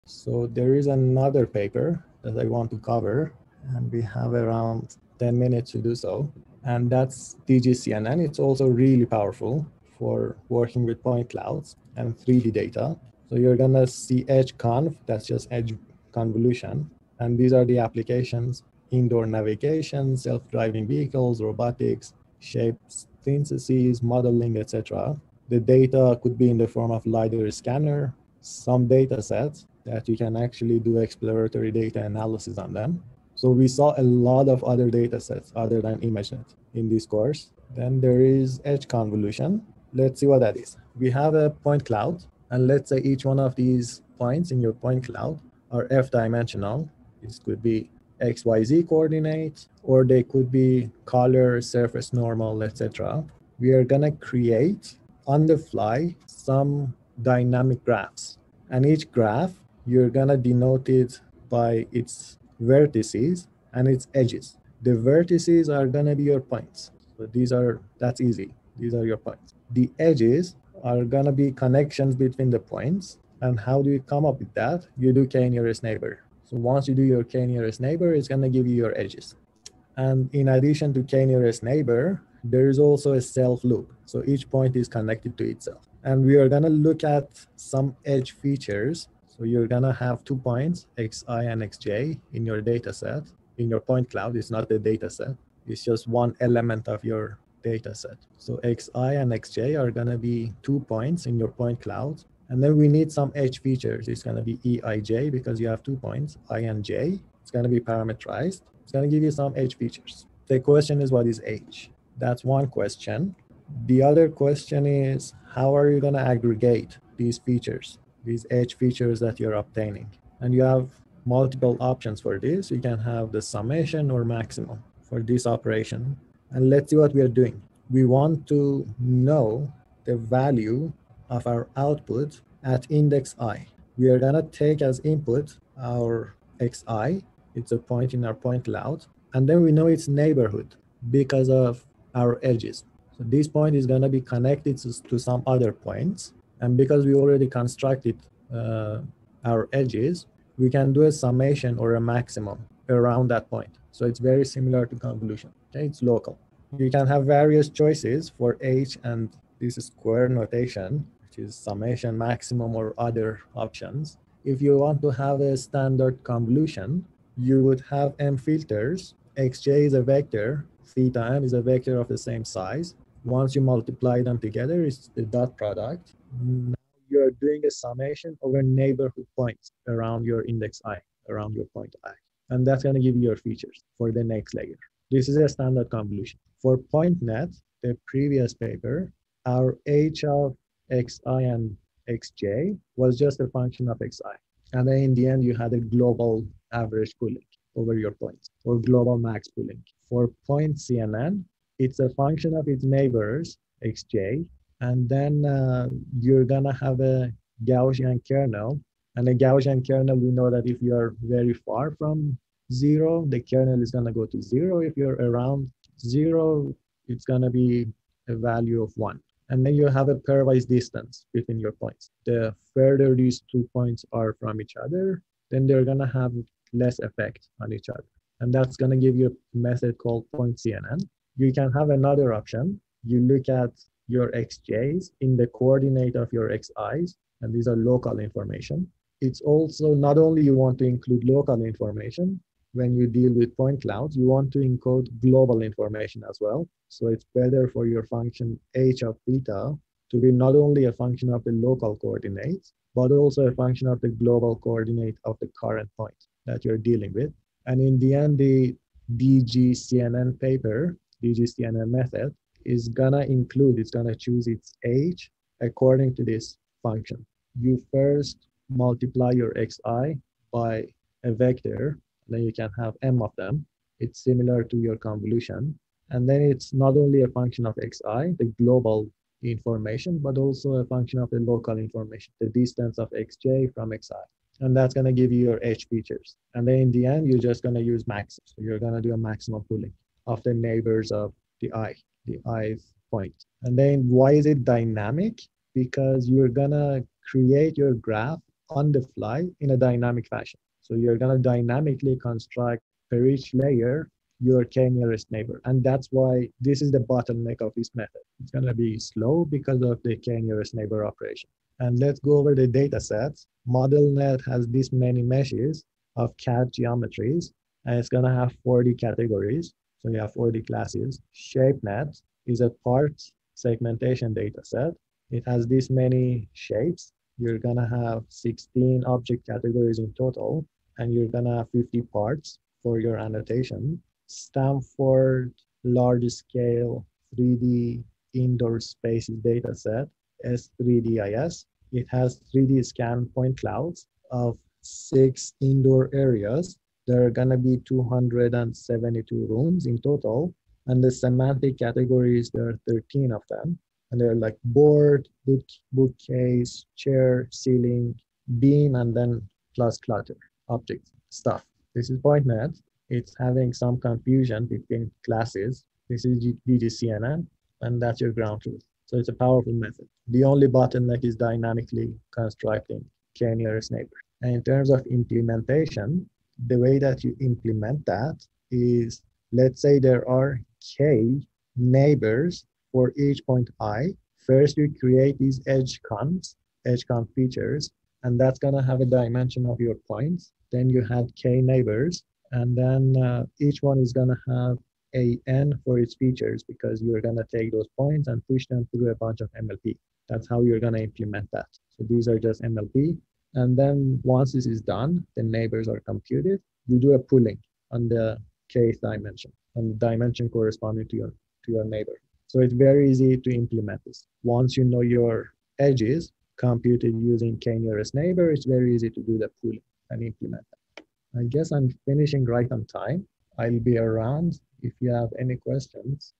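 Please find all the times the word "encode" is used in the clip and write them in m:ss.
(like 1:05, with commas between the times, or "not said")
4:04.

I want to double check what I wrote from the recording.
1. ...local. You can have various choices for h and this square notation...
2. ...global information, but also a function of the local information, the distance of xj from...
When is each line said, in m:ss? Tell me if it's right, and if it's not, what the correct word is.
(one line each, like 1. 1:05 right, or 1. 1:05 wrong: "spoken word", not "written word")
1. 2:36 right
2. 4:38 right.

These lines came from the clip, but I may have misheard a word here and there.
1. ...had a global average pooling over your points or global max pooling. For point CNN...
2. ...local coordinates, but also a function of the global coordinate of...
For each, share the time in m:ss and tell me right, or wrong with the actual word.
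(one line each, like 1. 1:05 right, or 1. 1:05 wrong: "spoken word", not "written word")
1. 3:15 right
2. 4:11 right.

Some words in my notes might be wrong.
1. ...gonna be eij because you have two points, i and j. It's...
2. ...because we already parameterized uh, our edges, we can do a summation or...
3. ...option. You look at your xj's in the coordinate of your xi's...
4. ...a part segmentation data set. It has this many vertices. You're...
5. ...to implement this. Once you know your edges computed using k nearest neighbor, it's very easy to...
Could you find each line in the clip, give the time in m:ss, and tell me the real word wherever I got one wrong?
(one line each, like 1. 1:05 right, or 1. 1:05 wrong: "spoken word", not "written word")
1. 1:44 right
2. 2:26 wrong: "constructed", not "parameterized"
3. 3:52 right
4. 5:22 wrong: "shapes", not "vertices"
5. 6:53 right.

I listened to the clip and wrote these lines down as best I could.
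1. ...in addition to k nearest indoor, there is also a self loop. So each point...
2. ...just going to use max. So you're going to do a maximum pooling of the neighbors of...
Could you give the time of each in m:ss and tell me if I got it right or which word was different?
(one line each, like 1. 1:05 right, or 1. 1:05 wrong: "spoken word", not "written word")
1. 1:20 wrong: "neighbor", not "indoor"
2. 4:47 right.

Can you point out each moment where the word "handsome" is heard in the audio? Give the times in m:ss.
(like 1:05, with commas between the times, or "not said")
not said.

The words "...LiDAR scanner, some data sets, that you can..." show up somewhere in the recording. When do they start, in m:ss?
0:27.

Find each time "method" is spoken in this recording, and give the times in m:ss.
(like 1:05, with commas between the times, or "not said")
3:49, 4:21, 5:07, 6:09.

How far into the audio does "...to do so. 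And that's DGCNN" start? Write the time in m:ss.
0:05.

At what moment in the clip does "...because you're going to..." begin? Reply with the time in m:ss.
6:36.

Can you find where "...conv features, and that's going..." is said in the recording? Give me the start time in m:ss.
6:27.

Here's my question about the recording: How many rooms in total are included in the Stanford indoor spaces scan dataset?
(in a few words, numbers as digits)
272.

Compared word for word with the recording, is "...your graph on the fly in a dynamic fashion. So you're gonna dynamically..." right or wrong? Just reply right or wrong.
right.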